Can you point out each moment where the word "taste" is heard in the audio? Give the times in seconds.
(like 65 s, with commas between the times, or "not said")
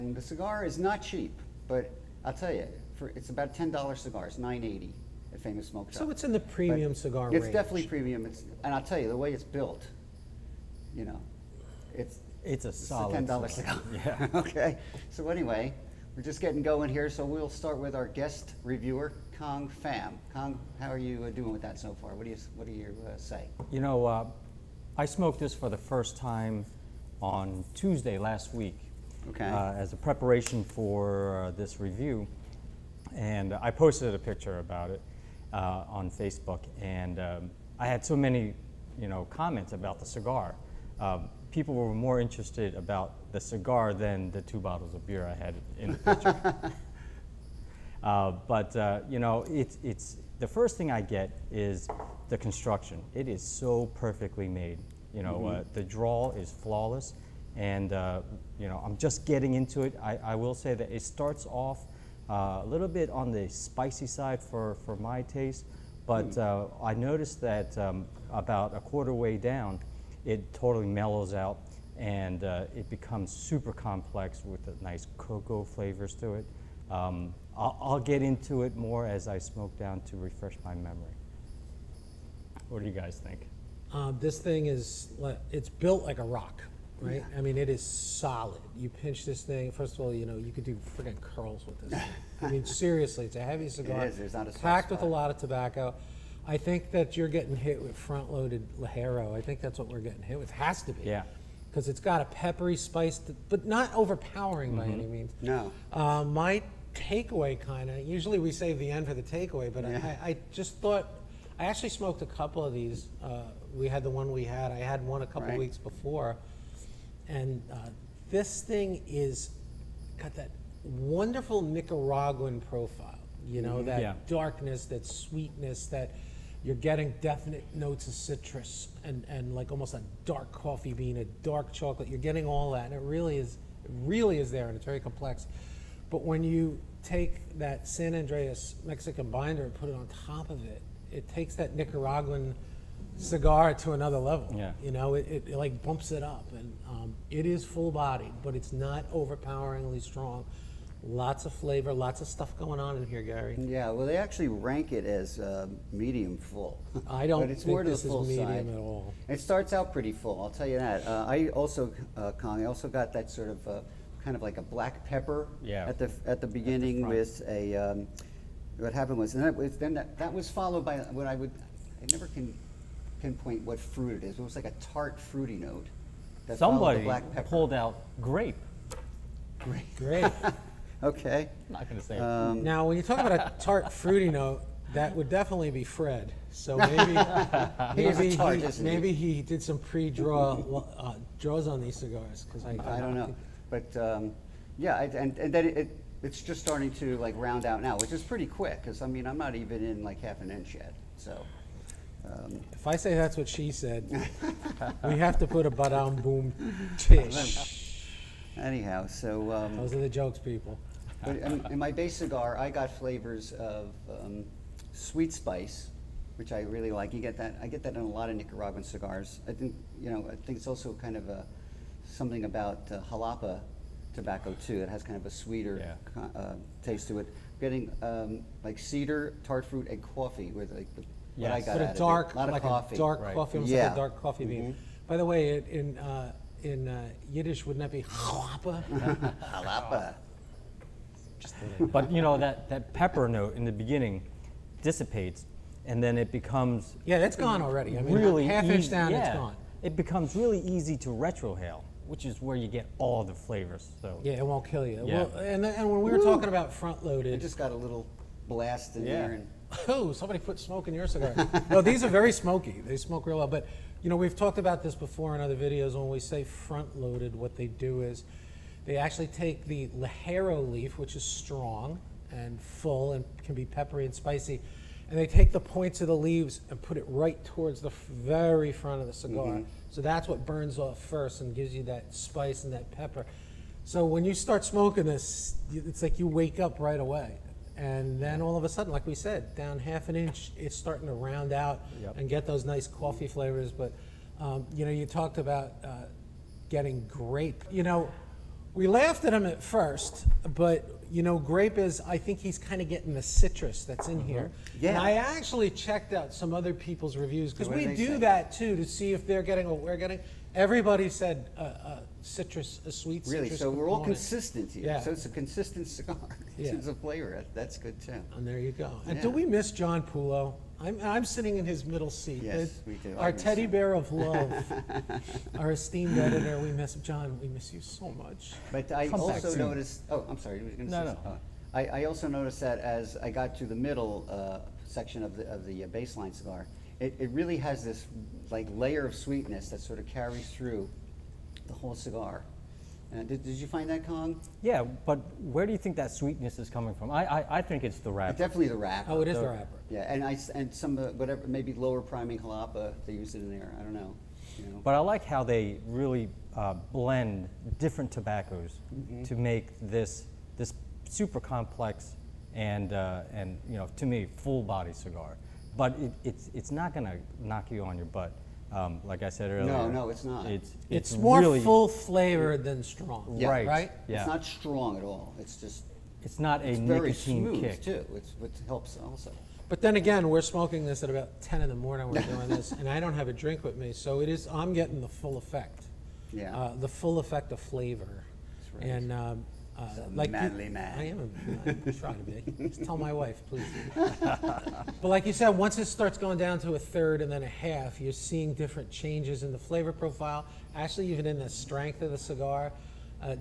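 65 s, 226 s.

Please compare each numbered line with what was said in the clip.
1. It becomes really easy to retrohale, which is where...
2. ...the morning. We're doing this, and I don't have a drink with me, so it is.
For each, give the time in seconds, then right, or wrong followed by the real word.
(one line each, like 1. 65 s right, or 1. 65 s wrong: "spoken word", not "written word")
1. 249 s right
2. 381 s right.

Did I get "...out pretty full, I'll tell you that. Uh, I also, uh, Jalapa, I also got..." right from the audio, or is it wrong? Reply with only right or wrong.
wrong.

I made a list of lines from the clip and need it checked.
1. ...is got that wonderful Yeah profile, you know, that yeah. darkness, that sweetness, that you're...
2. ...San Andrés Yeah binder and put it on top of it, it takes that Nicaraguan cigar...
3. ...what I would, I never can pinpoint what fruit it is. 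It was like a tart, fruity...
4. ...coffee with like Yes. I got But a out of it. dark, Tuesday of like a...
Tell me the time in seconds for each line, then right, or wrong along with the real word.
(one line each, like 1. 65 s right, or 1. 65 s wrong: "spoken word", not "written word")
1. 119 s wrong: "Nicaraguan", not "Yeah"
2. 137 s wrong: "Mexican", not "Yeah"
3. 171 s right
4. 230 s wrong: "Lot", not "Tuesday".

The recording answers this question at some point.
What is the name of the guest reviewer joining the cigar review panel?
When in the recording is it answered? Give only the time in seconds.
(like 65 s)
19 s.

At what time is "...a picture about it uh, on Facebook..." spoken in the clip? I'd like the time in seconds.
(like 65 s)
34 s.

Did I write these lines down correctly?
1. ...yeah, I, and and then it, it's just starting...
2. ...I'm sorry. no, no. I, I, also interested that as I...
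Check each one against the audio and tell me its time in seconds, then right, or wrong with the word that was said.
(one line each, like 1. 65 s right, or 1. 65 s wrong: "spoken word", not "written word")
1. 194 s right
2. 330 s wrong: "noticed", not "interested".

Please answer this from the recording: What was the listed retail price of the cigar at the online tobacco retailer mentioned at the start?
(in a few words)
$9.80.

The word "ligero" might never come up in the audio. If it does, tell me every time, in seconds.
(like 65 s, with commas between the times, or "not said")
98 s, 269 s.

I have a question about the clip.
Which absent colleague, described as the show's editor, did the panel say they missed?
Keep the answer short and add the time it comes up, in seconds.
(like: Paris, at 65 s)
John Pullo, at 319 s.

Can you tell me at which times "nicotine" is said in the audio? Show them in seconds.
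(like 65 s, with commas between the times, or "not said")
376 s.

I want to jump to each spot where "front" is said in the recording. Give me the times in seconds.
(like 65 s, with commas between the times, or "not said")
97 s, 256 s, 266 s, 278 s.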